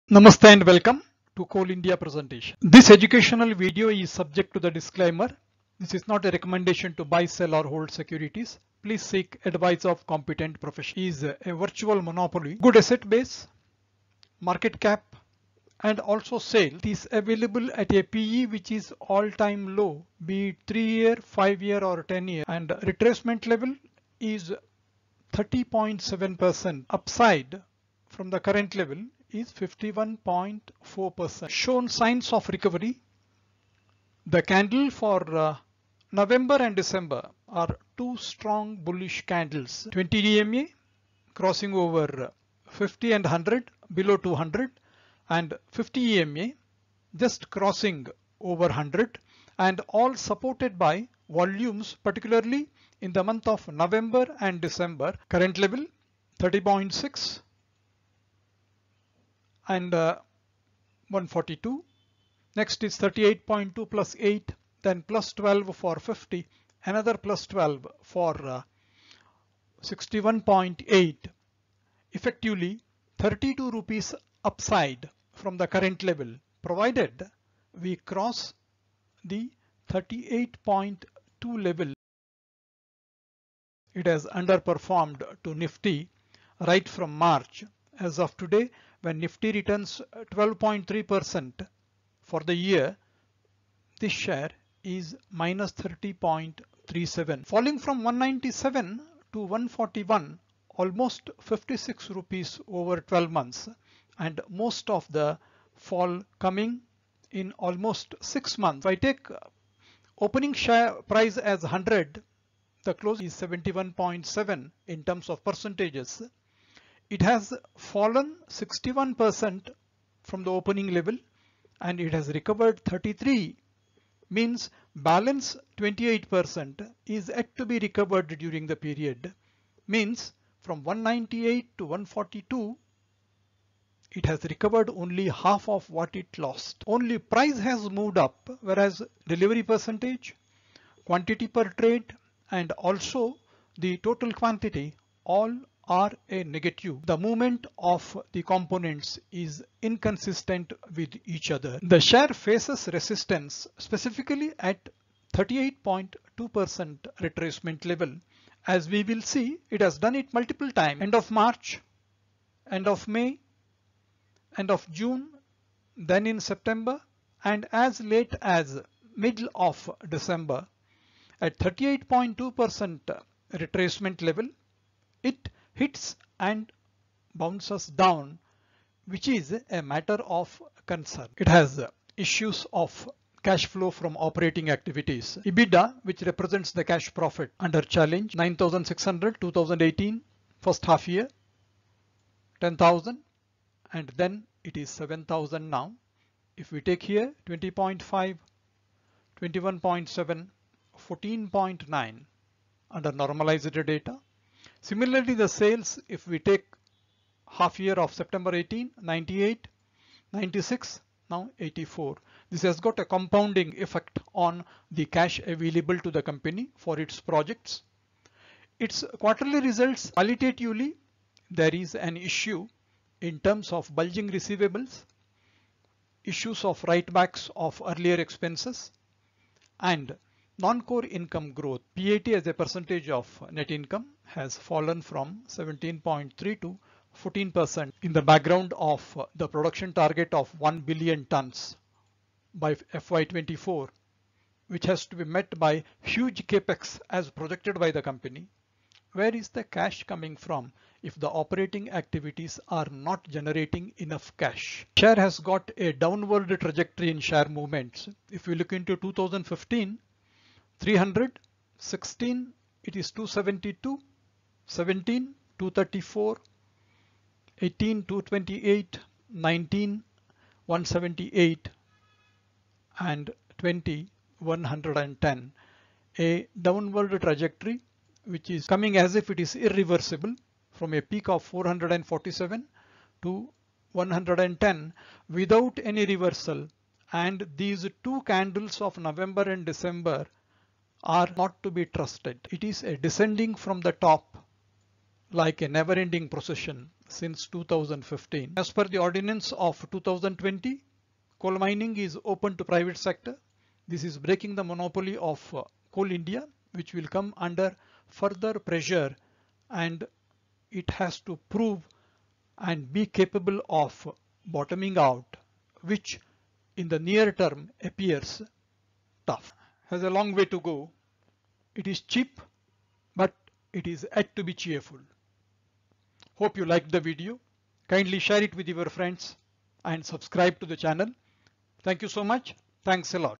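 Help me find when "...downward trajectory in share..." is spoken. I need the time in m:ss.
4:15.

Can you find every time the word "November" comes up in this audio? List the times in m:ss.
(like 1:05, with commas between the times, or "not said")
0:36, 0:53.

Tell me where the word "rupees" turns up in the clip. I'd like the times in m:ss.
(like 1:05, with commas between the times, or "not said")
1:13, 1:42.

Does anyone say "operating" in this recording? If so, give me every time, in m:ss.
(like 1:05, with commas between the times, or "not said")
3:04, 4:11.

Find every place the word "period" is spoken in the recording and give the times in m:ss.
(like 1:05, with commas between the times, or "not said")
2:08.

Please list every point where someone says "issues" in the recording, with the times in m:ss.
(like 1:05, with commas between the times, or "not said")
3:02, 3:42, 3:46.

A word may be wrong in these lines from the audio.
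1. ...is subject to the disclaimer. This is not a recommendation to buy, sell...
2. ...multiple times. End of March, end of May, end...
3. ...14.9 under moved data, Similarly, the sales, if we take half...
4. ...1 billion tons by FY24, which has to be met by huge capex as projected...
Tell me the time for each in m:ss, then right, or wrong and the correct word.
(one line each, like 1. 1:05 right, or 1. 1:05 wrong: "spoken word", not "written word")
1. 0:03 right
2. 2:40 right
3. 3:21 wrong: "normalized", not "moved"
4. 4:00 right.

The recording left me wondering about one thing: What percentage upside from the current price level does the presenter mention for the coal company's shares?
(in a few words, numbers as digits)
51.4%.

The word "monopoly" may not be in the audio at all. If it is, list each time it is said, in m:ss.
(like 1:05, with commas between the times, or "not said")
0:12, 5:04.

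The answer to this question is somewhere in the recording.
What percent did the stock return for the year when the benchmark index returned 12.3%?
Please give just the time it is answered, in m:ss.
1:35.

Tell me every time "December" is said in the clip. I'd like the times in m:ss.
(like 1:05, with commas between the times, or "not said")
0:36, 0:54, 2:50.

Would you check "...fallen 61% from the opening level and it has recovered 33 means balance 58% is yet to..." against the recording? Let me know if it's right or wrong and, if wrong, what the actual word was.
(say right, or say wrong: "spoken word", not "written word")
wrong: "28", not "58".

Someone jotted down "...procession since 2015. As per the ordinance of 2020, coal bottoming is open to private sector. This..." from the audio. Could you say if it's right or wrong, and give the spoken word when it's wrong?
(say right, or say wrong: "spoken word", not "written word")
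wrong: "mining", not "bottoming".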